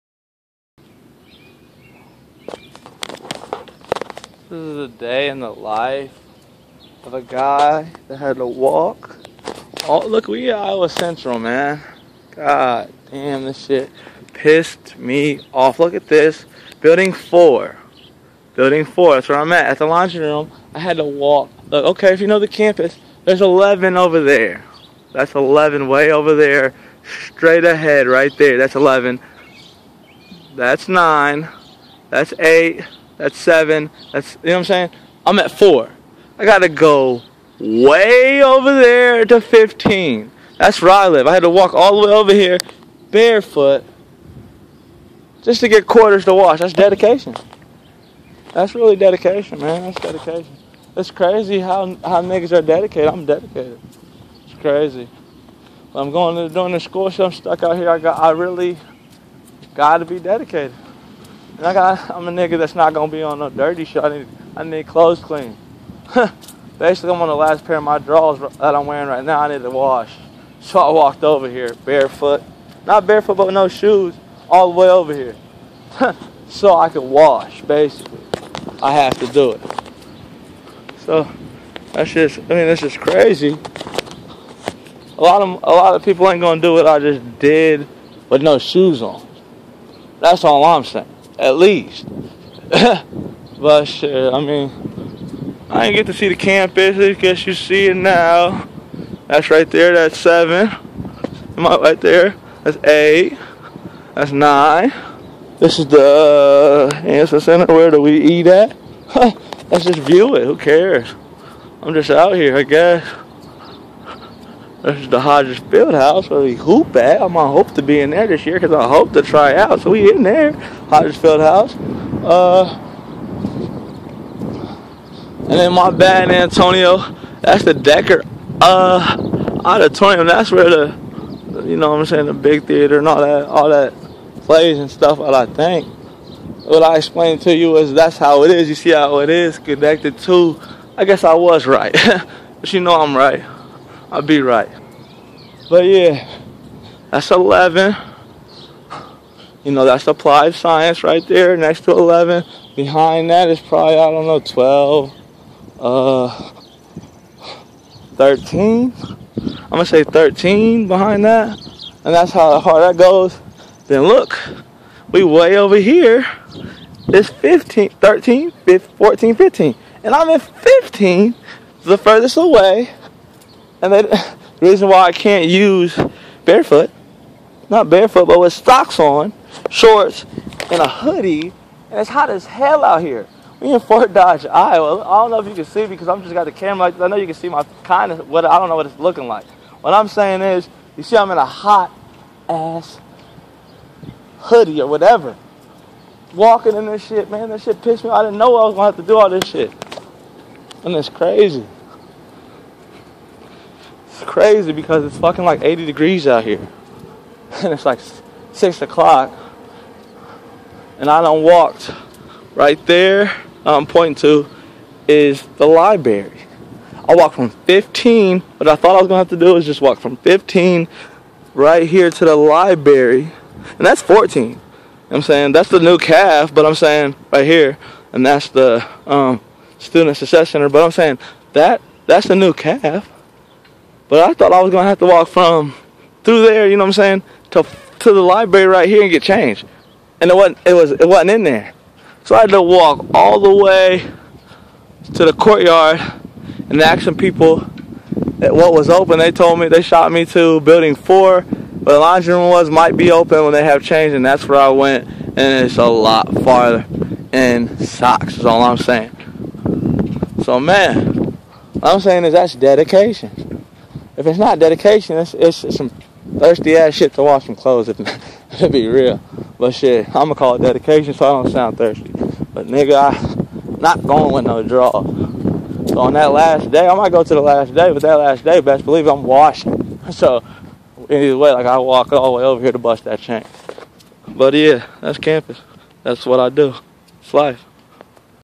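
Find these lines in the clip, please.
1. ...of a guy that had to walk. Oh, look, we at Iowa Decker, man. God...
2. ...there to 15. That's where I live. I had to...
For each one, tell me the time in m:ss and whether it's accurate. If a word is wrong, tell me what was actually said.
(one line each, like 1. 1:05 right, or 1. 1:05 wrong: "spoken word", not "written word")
1. 0:07 wrong: "Central", not "Decker"
2. 0:38 right.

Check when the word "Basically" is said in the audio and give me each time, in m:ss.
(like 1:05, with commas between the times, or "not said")
1:06, 1:17.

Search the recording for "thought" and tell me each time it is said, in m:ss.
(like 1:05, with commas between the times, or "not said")
3:38, 3:54.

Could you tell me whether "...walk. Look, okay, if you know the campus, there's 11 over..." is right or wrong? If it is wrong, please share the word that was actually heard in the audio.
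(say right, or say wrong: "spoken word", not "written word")
right.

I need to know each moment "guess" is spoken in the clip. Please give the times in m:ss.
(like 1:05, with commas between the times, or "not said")
1:37, 1:52, 2:21.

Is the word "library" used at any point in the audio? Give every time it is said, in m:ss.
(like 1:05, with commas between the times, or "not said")
3:35, 3:42, 3:58.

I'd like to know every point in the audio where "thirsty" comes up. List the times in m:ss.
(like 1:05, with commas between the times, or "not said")
4:26, 4:31.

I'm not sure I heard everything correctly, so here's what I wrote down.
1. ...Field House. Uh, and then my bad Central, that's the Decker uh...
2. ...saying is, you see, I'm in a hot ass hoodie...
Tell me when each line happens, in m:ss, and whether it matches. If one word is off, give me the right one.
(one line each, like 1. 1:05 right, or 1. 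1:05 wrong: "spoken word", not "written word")
1. 2:01 wrong: "Antonio", not "Central"
2. 3:10 right.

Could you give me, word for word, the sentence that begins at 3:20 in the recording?
And it's crazy crazy because it's fucking like 80 degrees out here.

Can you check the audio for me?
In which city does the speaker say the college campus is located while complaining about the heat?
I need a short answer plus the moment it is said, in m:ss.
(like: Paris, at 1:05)
Fort Dodge, Iowa, at 3:03.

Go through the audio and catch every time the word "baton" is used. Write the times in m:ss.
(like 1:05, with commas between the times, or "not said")
not said.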